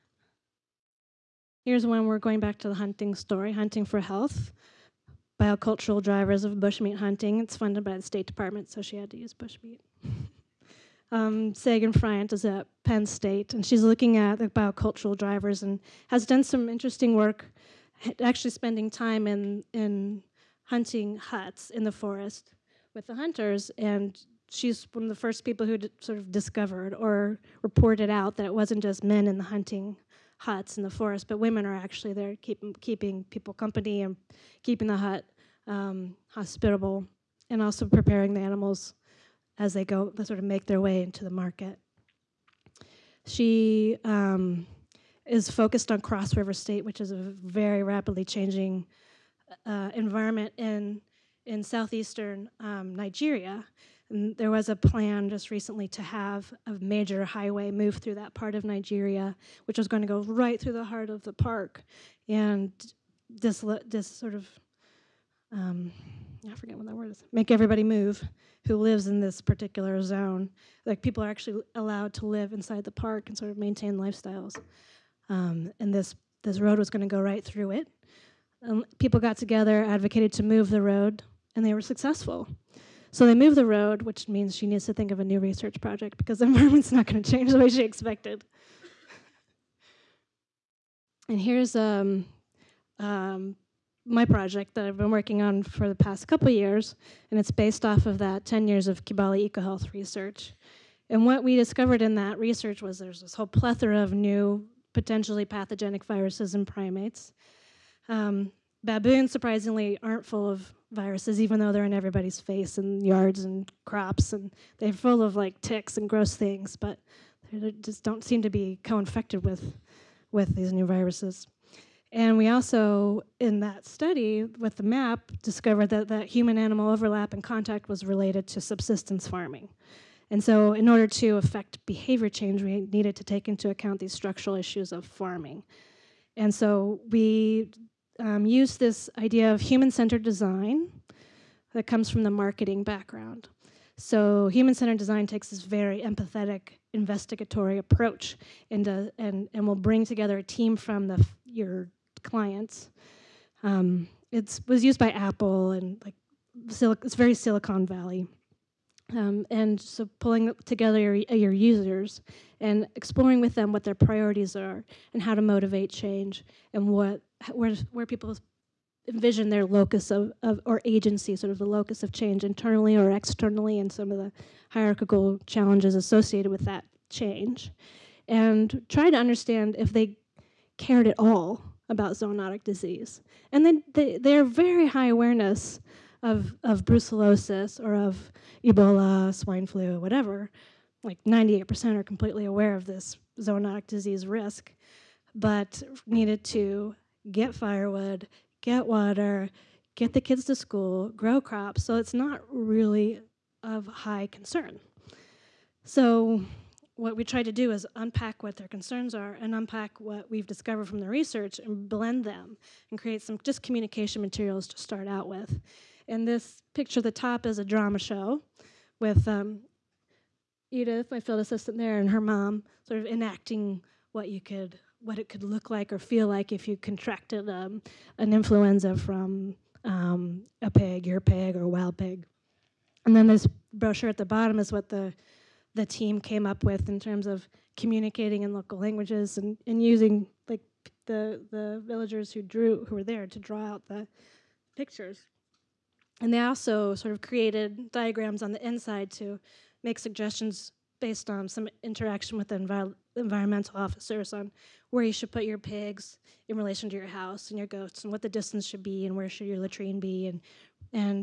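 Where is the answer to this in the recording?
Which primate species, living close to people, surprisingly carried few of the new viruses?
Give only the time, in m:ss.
1:48.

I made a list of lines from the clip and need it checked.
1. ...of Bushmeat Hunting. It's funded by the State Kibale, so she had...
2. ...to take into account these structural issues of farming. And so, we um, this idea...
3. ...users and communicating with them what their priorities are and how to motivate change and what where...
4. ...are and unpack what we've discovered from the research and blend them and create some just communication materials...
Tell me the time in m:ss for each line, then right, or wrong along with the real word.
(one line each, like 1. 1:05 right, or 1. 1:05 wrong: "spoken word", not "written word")
1. 0:06 wrong: "Department", not "Kibale"
2. 2:13 right
3. 2:41 wrong: "exploring", not "communicating"
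4. 3:29 right.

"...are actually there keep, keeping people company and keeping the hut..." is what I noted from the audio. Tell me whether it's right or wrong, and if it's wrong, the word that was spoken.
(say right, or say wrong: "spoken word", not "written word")
right.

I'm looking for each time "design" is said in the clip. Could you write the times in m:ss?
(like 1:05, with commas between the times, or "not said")
2:20, 2:24.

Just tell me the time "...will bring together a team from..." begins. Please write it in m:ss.
2:29.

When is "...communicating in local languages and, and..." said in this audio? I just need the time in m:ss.
3:57.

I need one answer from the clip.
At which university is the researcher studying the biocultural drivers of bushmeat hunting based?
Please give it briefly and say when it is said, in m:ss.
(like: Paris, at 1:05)
Penn State, at 0:12.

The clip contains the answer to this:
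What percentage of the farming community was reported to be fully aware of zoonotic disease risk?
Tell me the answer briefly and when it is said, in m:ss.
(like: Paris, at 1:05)
98%, at 3:11.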